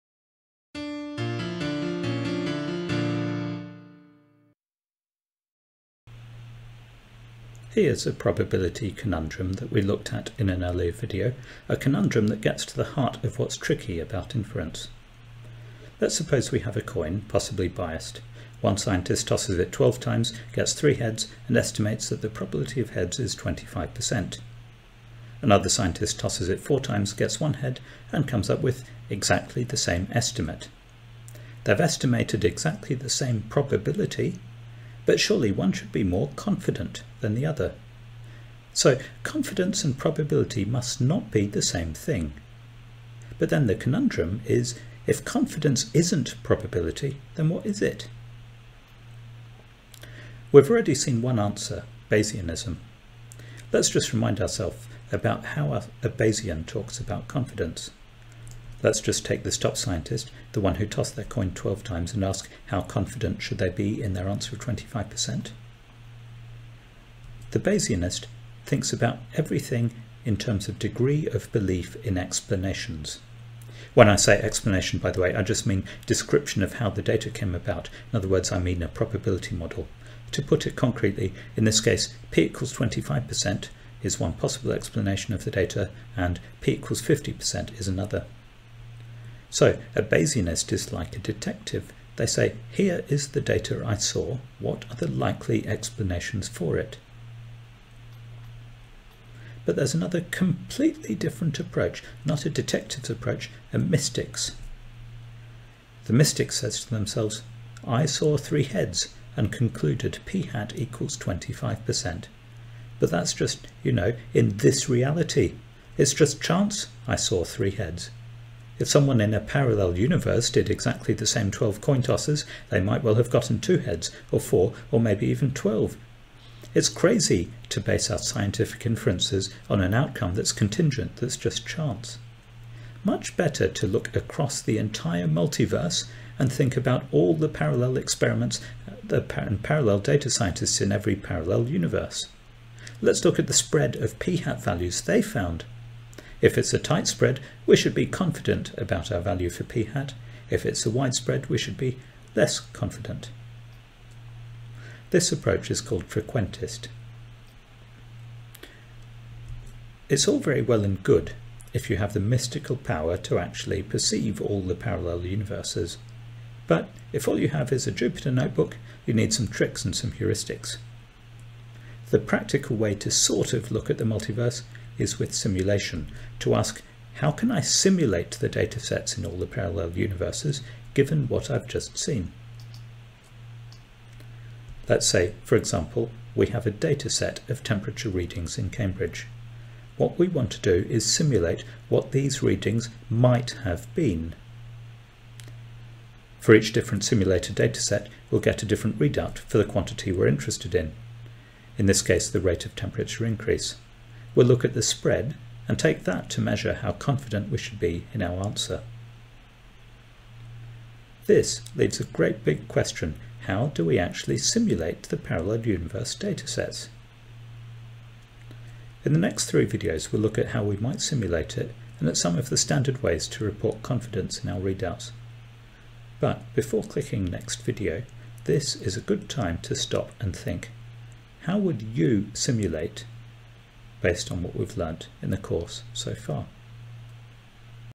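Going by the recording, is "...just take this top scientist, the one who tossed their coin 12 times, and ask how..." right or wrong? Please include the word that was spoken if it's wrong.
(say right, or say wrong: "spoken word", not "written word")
right.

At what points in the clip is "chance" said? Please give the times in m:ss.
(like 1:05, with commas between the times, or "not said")
1:56, 2:11.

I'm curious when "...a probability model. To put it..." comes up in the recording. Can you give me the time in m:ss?
1:18.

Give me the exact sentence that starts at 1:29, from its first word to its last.
So a Bayesian is like a detective.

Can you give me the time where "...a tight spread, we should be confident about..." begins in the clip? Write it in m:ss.
2:26.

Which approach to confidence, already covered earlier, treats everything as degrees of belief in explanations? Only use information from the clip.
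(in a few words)
Bayesianism.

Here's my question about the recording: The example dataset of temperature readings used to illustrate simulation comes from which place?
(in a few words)
Cambridge.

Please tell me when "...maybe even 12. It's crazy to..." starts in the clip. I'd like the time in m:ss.
2:04.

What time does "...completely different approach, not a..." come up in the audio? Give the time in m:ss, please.
1:40.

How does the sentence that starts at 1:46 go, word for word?
The mystic says to themselves, I saw three heads and concluded p hat equals 25%.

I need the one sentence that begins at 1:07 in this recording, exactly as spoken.
The Bayesianist thinks about everything in terms of degree of belief in explanations.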